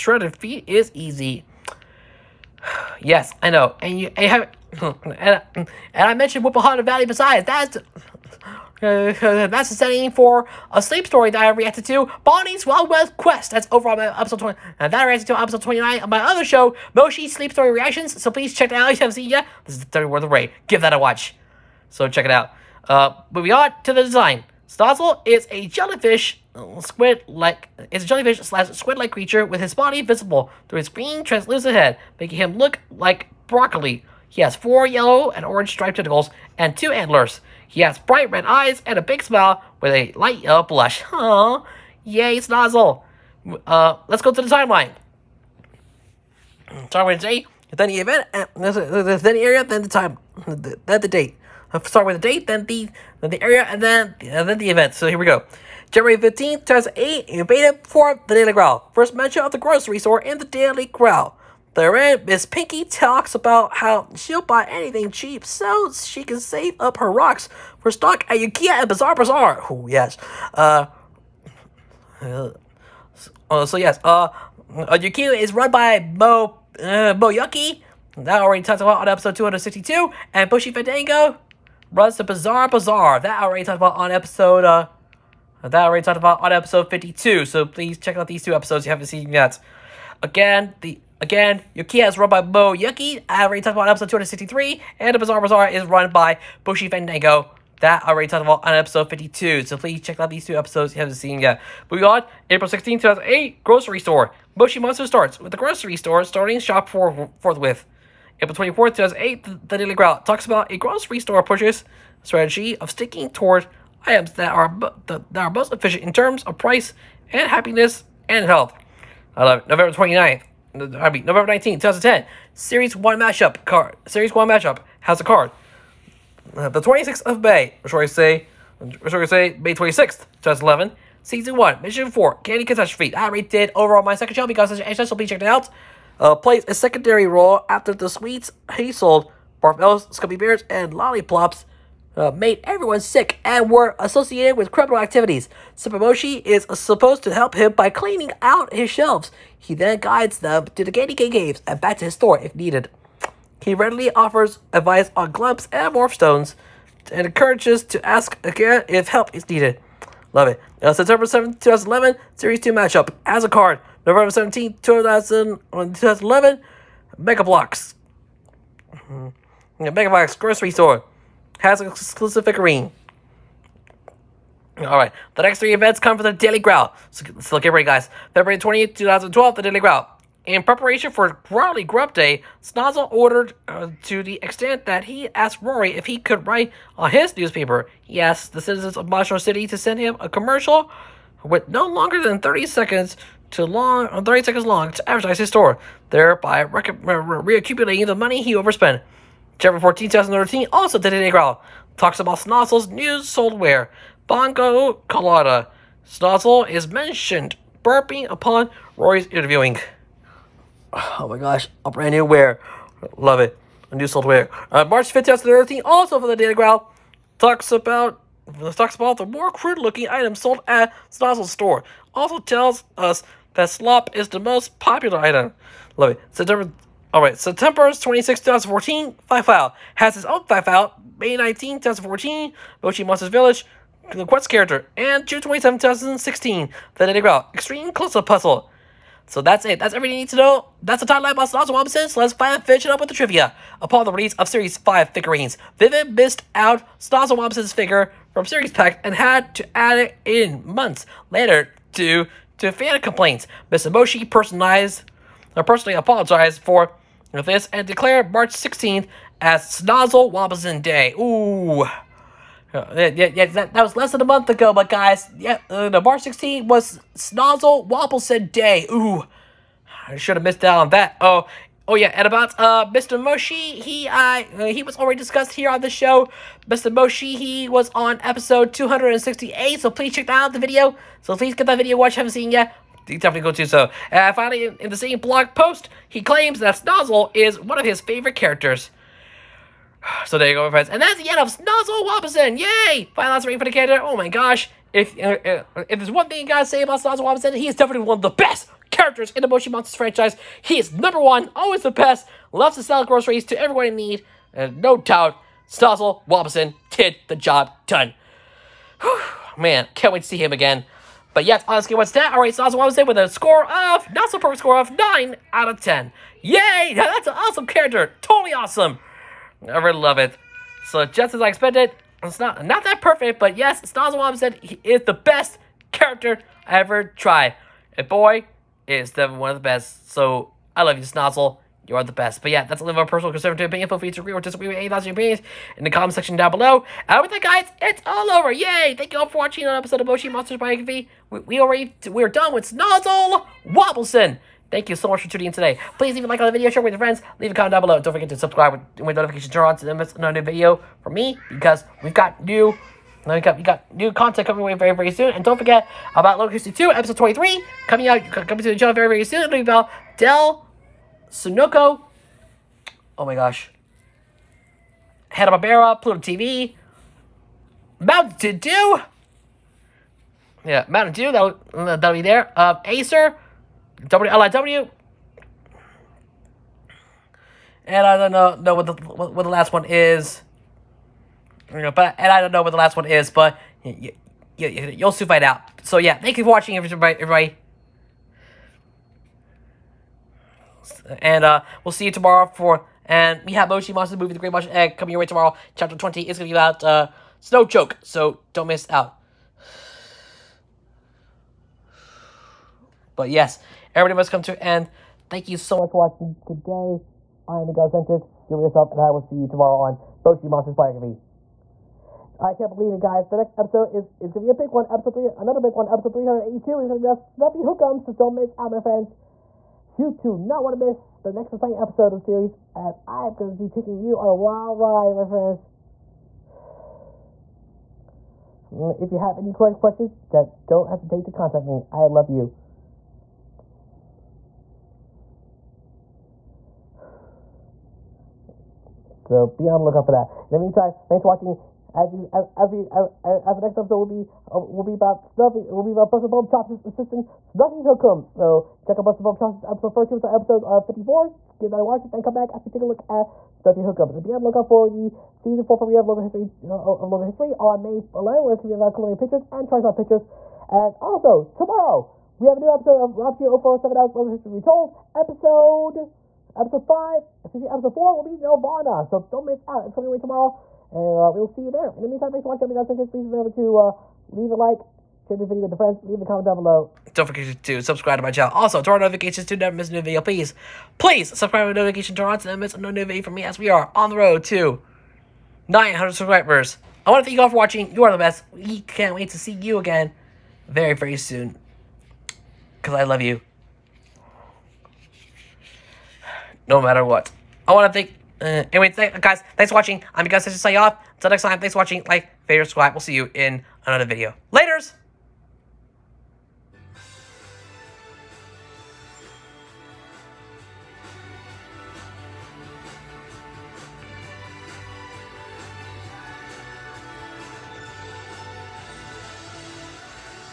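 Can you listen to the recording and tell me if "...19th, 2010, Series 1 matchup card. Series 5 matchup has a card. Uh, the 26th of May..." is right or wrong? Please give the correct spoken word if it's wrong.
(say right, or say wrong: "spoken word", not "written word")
wrong: "1", not "5".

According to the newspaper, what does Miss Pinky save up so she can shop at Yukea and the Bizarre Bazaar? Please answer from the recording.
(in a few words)
rocks.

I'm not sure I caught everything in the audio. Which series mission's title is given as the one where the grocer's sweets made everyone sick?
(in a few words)
Candy Catastrophe.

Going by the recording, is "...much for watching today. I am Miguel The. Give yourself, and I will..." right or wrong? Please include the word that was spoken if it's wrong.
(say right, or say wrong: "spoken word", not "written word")
wrong: "Sanchez", not "The".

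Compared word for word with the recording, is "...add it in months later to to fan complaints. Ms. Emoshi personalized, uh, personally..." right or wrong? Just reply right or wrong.
right.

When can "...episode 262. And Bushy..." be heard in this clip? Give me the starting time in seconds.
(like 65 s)
79 s.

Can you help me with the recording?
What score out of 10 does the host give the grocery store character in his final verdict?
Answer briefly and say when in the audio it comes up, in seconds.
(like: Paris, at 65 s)
9, at 314 s.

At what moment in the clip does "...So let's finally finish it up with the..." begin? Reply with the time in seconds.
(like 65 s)
242 s.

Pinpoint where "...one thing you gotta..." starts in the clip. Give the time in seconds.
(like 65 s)
296 s.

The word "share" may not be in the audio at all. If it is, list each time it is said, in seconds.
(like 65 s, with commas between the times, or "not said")
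346 s, 475 s.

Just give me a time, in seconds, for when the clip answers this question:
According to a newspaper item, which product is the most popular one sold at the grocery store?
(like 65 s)
223 s.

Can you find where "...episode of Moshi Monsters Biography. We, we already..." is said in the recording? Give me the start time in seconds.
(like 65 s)
339 s.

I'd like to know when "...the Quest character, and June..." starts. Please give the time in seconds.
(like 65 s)
234 s.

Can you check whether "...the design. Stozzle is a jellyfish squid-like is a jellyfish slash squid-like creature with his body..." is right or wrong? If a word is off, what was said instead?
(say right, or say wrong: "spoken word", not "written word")
right.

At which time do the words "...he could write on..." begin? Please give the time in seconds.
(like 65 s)
186 s.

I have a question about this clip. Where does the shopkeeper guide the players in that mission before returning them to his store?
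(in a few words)
Candy Cane Caves.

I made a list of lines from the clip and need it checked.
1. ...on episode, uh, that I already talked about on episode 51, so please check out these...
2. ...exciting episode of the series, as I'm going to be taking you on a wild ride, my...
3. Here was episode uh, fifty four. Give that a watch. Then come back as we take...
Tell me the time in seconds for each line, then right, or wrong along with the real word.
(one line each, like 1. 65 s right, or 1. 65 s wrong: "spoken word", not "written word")
1. 83 s wrong: "52", not "51"
2. 421 s right
3. 450 s right.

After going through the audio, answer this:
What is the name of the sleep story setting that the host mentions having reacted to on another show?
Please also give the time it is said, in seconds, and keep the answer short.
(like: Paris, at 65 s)
Bonnie's Wild West Quest, at 12 s.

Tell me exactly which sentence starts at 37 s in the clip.
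He has bright red eyes and a big smile with a light yellow blush.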